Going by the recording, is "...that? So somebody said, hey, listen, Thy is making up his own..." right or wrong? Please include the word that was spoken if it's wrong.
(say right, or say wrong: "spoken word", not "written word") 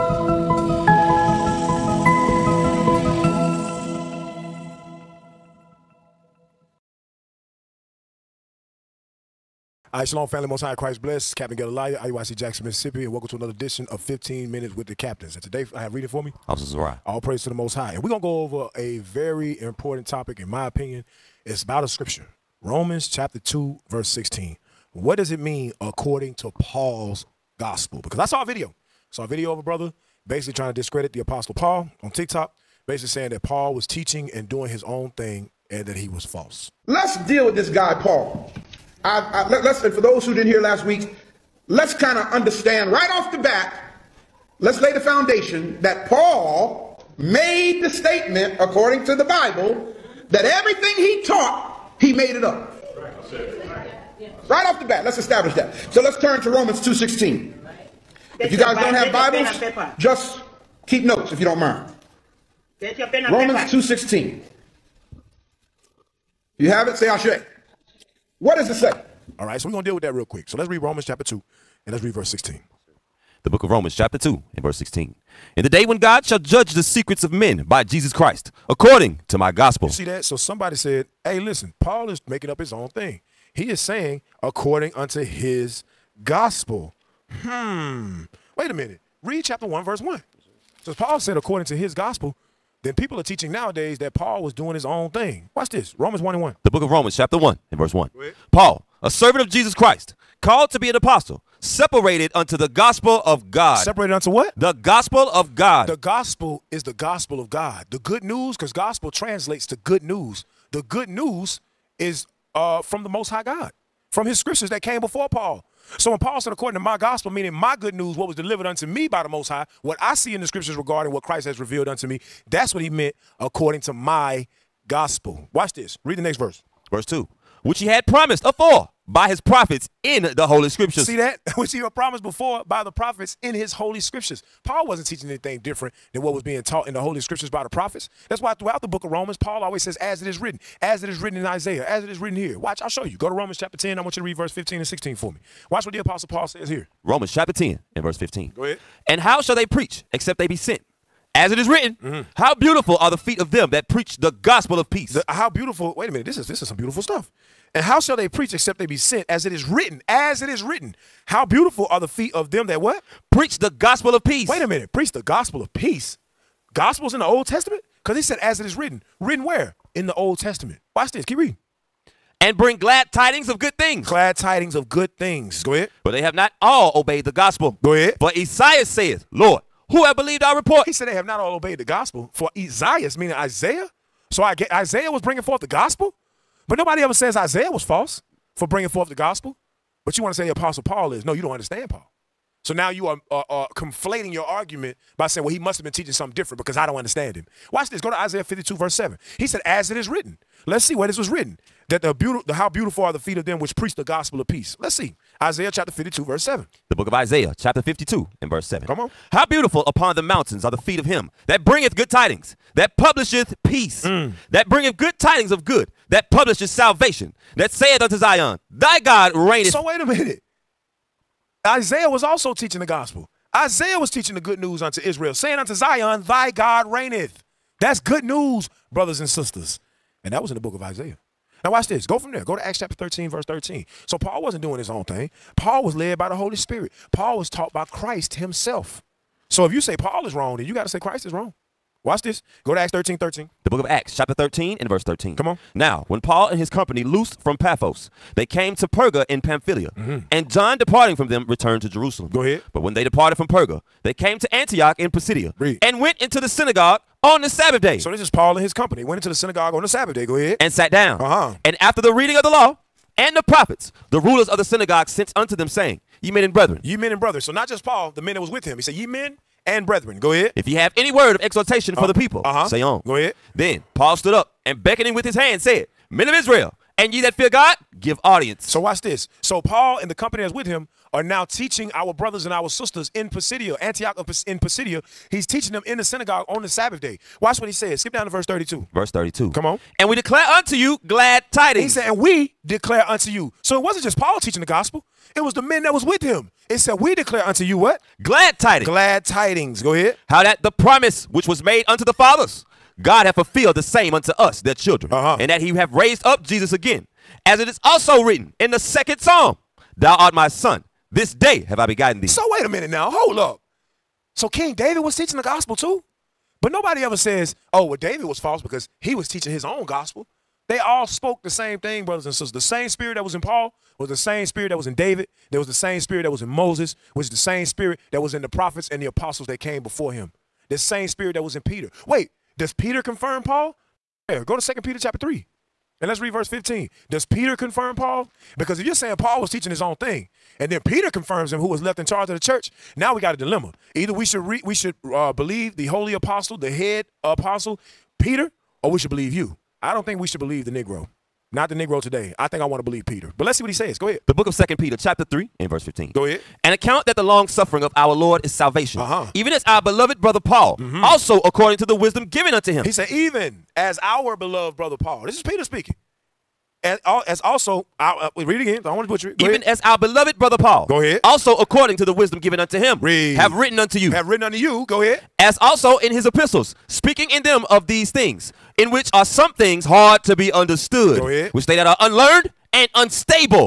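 wrong: "Paul", not "Thy".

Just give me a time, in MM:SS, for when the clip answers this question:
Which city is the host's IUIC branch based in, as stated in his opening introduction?
00:12.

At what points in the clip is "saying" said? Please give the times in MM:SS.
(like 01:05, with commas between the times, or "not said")
00:33, 01:23, 03:15, 03:45, 04:25, 05:38.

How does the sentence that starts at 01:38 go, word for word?
Paul, a servant of Jesus Christ, called to be an apostle, separated unto the gospel of God.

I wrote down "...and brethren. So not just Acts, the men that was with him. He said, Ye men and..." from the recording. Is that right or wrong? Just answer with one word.
wrong.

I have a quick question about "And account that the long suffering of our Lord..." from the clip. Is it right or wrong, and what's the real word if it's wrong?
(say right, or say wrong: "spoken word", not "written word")
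right.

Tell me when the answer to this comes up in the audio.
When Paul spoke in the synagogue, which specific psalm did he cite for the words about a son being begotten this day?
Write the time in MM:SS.
05:08.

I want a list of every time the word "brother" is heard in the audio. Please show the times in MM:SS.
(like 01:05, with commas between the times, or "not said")
00:29, 03:48, 04:42, 05:22, 06:00, 06:04, 06:10.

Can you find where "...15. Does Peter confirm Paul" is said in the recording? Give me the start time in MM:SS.
05:36.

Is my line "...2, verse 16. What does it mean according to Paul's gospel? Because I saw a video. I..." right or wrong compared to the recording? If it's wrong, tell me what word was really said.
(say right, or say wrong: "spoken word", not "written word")
right.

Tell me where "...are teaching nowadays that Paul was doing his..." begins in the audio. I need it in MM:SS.
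01:33.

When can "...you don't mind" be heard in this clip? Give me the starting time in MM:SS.
01:01.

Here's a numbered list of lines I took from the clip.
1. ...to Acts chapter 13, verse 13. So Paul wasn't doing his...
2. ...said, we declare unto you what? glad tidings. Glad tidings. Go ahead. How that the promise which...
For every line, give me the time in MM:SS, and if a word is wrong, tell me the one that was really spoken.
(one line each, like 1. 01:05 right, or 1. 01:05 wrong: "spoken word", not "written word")
1. 03:52 right
2. 04:56 right.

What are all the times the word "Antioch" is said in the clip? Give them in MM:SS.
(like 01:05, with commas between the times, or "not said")
04:14, 04:43.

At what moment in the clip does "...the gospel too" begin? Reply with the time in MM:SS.
05:15.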